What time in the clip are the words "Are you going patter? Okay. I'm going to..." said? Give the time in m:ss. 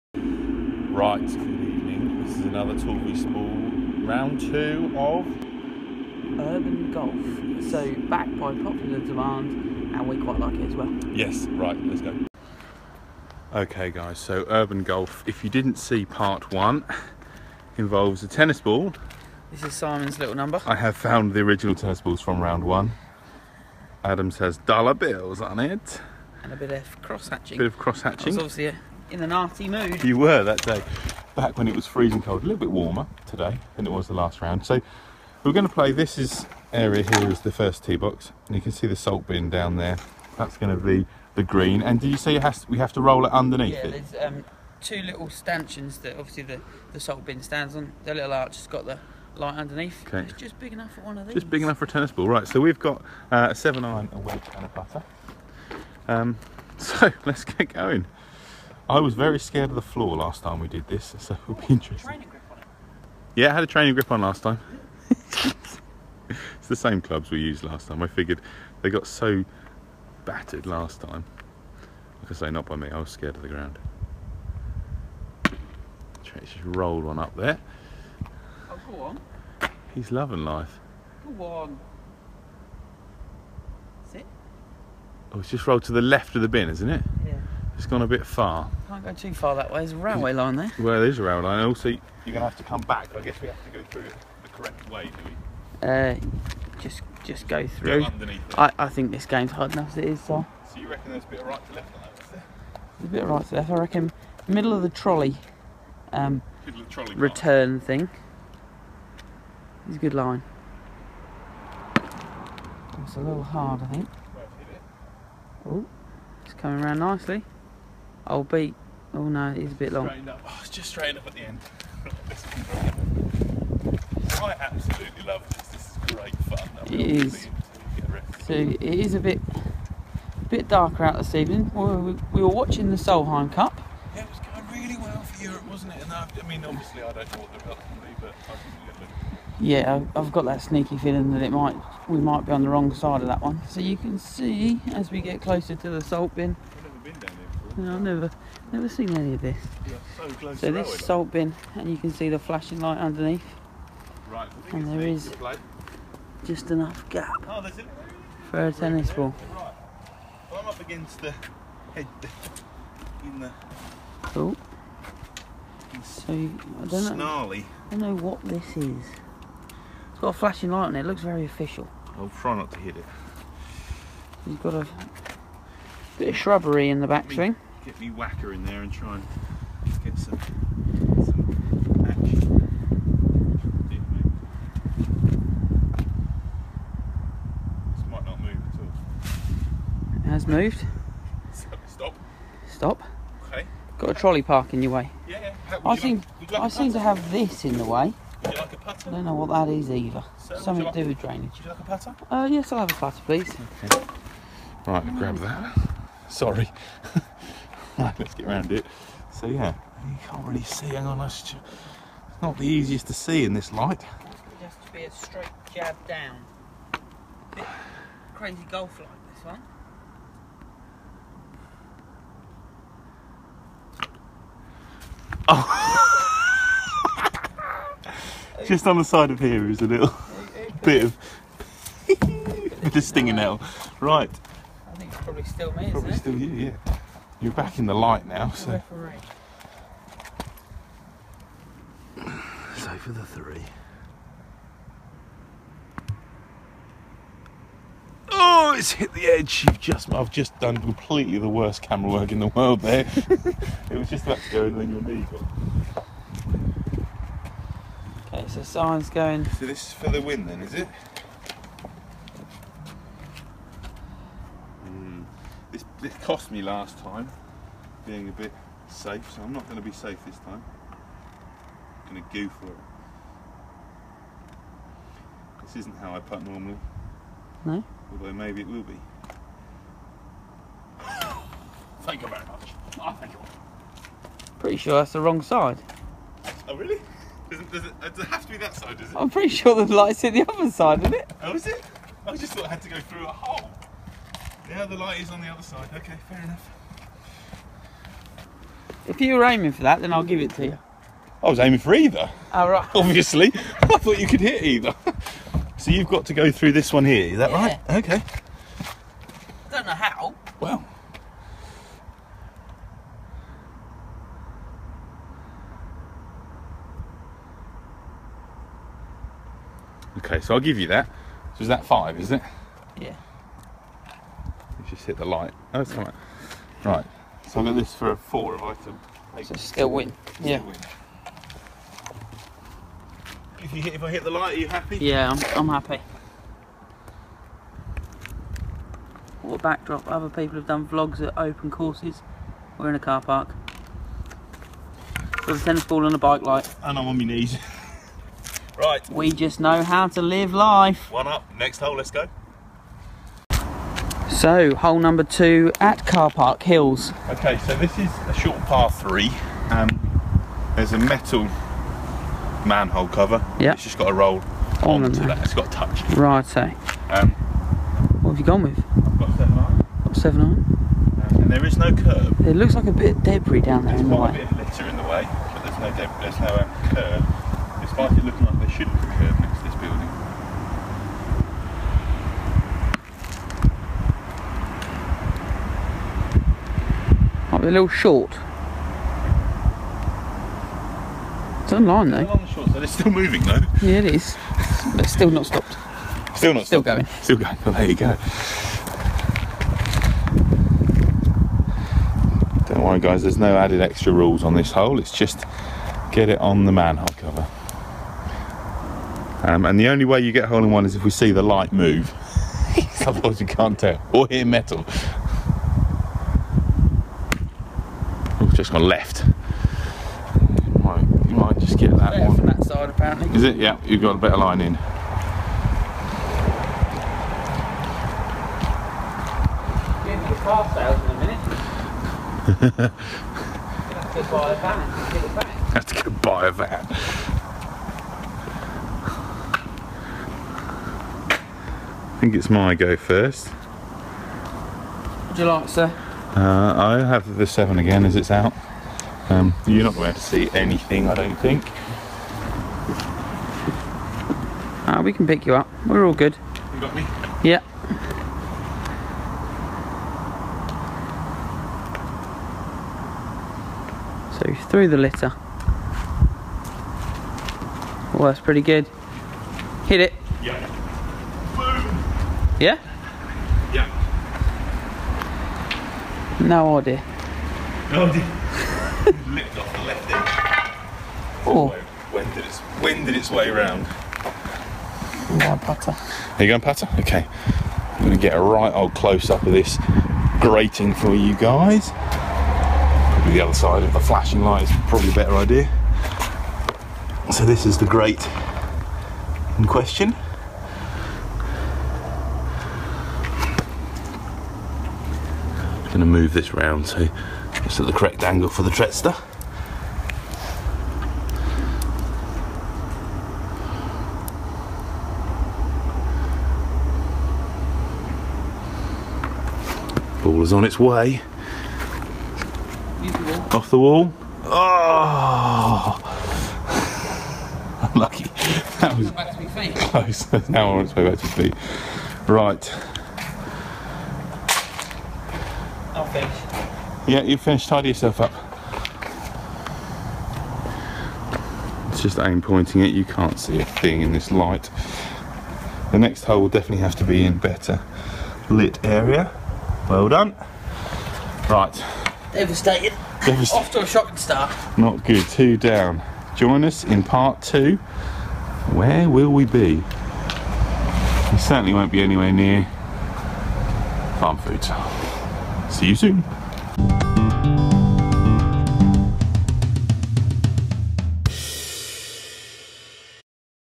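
8:05.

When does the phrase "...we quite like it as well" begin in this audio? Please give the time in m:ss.
0:10.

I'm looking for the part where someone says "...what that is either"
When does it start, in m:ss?
3:19.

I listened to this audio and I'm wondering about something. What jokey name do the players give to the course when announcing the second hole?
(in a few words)
Car Park Hills.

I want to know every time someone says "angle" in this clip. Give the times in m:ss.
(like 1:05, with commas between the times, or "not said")
8:28.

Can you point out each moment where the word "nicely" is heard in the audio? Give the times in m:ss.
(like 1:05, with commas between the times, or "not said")
1:56.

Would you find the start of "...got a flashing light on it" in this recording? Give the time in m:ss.
2:50.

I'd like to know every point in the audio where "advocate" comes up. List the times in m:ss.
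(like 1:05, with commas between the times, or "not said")
not said.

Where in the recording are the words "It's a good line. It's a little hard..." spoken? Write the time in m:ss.
1:49.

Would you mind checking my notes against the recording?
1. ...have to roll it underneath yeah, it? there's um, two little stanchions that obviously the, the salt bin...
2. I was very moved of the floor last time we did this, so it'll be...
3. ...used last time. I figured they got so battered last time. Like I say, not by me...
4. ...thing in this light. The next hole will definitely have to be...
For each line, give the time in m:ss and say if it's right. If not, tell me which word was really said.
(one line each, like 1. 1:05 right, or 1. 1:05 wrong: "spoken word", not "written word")
1. 0:42 right
2. 0:58 wrong: "scared", not "moved"
3. 1:07 right
4. 9:03 right.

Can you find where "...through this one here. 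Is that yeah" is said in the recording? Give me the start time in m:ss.
5:06.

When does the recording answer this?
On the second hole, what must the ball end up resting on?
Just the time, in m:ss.
6:00.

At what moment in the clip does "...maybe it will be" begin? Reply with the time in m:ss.
4:38.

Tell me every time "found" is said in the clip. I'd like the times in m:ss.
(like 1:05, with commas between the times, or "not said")
0:20.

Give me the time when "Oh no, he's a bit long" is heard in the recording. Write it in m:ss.
1:59.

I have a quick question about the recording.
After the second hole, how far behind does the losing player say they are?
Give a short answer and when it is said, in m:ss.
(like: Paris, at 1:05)
Two down, at 9:15.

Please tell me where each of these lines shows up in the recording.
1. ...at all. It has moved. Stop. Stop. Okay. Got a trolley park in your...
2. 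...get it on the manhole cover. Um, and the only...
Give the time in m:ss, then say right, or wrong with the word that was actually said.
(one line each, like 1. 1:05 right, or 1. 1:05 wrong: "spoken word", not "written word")
1. 3:08 right
2. 6:46 right.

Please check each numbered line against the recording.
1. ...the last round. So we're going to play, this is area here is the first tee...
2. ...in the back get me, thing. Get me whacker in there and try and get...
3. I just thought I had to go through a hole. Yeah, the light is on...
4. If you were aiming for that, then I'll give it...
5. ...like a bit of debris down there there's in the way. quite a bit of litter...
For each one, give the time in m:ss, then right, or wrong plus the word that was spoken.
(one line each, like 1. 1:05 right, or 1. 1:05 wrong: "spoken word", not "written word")
1. 0:34 right
2. 2:56 right
3. 4:52 right
4. 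4:59 right
5. 6:12 right.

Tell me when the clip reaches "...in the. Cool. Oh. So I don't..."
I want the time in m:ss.
2:43.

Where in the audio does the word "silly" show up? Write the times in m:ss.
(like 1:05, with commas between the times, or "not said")
not said.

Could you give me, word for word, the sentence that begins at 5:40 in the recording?
Other people have done vlogs at open courses.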